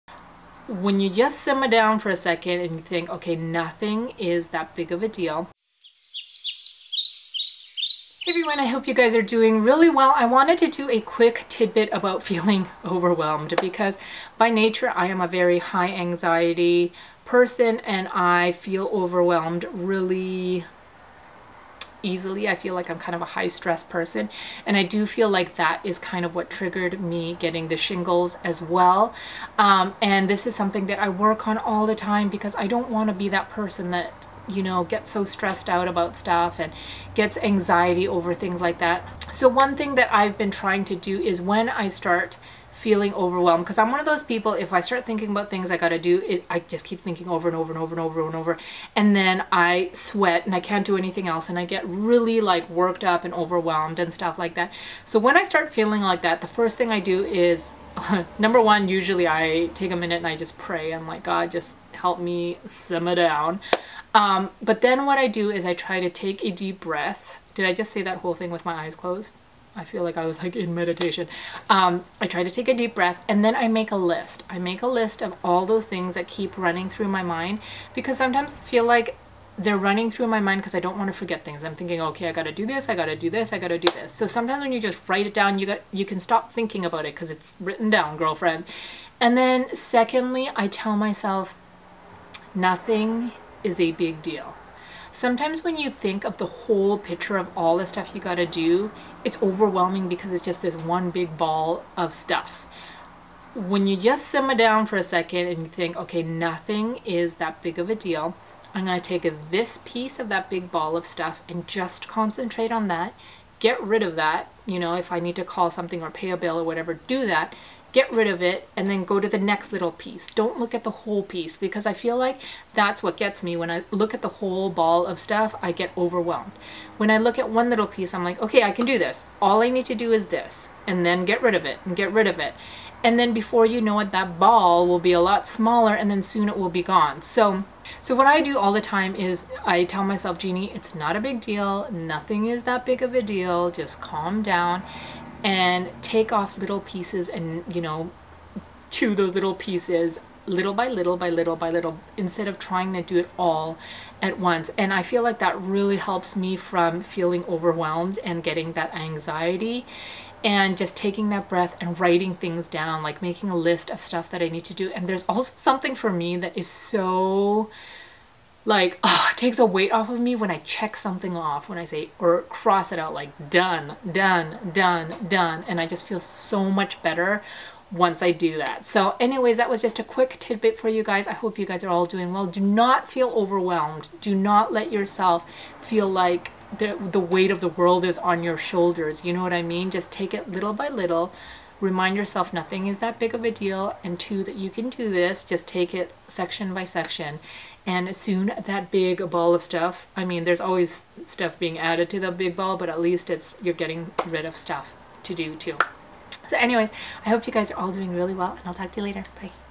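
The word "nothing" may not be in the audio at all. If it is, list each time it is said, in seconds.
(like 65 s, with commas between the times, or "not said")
3 s, 92 s, 106 s, 141 s, 192 s.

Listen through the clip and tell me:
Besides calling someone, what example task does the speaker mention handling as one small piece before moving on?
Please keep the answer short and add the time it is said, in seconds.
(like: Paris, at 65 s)
pay a bill, at 116 s.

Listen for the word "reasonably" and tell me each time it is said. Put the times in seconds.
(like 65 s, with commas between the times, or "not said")
not said.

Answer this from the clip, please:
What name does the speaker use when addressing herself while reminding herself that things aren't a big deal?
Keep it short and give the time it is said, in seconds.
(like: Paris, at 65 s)
Jeannie, at 140 s.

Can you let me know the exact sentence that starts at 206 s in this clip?
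So anyways, I hope you guys are all doing really well and I'll talk to you later.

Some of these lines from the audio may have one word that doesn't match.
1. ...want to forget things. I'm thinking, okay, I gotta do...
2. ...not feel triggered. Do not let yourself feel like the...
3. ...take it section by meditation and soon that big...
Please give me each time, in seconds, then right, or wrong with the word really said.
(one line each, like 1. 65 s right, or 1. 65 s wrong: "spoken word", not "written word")
1. 80 s right
2. 182 s wrong: "overwhelmed", not "triggered"
3. 195 s wrong: "section", not "meditation".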